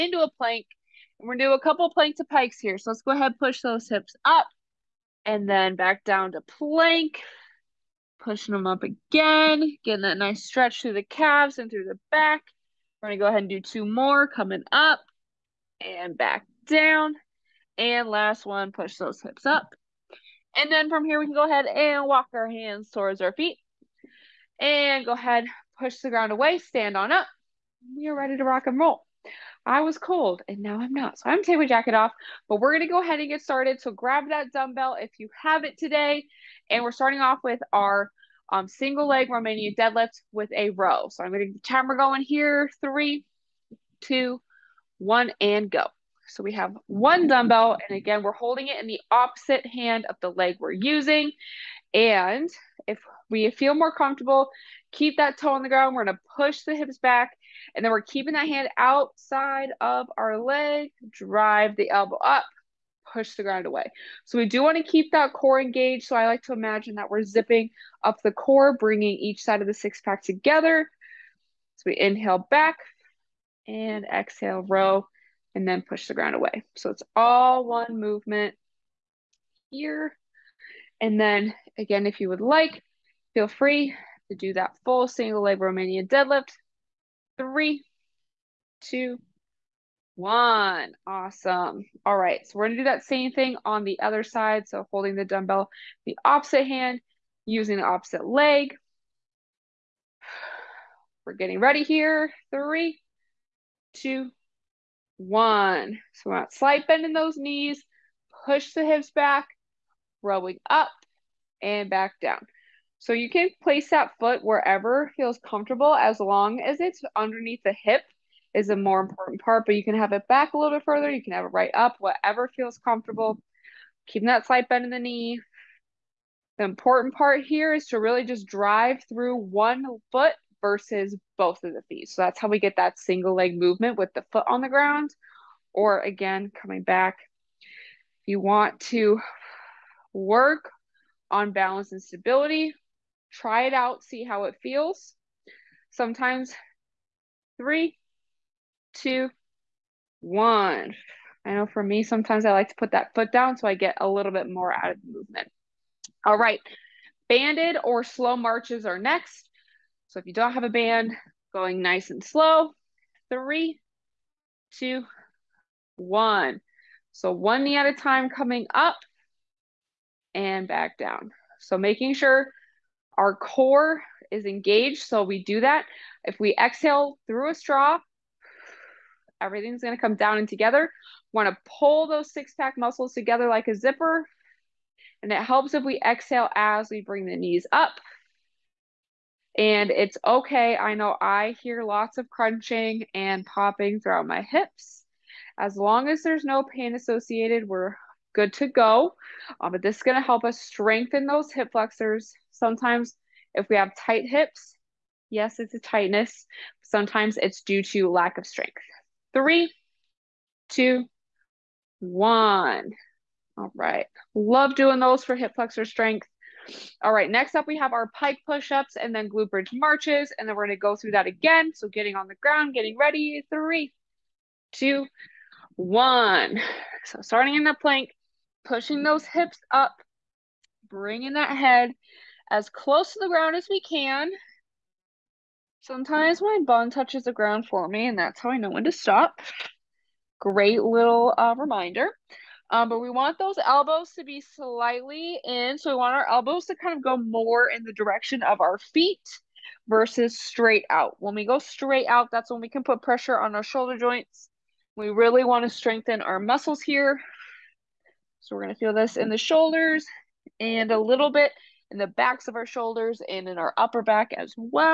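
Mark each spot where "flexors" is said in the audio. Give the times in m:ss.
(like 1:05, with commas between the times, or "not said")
3:21, 3:35.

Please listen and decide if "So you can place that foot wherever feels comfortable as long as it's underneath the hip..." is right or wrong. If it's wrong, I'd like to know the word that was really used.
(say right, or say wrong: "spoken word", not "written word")
right.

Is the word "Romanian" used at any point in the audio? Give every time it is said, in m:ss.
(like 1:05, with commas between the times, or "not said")
0:39, 1:25.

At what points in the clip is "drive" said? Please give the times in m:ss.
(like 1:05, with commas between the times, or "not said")
1:01, 2:08.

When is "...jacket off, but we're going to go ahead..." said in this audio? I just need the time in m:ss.
0:31.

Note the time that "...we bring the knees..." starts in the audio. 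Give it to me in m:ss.
3:06.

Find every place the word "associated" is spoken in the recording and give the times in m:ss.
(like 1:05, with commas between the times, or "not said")
3:16.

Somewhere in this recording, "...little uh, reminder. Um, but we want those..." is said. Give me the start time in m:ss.
4:00.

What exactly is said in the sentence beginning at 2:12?
So that's how we get that single leg movement with the foot on the ground or again coming back.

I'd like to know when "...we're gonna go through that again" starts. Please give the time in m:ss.
3:40.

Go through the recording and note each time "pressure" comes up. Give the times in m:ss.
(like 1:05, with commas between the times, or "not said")
4:13.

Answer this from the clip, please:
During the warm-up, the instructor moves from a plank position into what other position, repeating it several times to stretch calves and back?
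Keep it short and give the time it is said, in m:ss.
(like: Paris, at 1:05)
pikes, at 0:02.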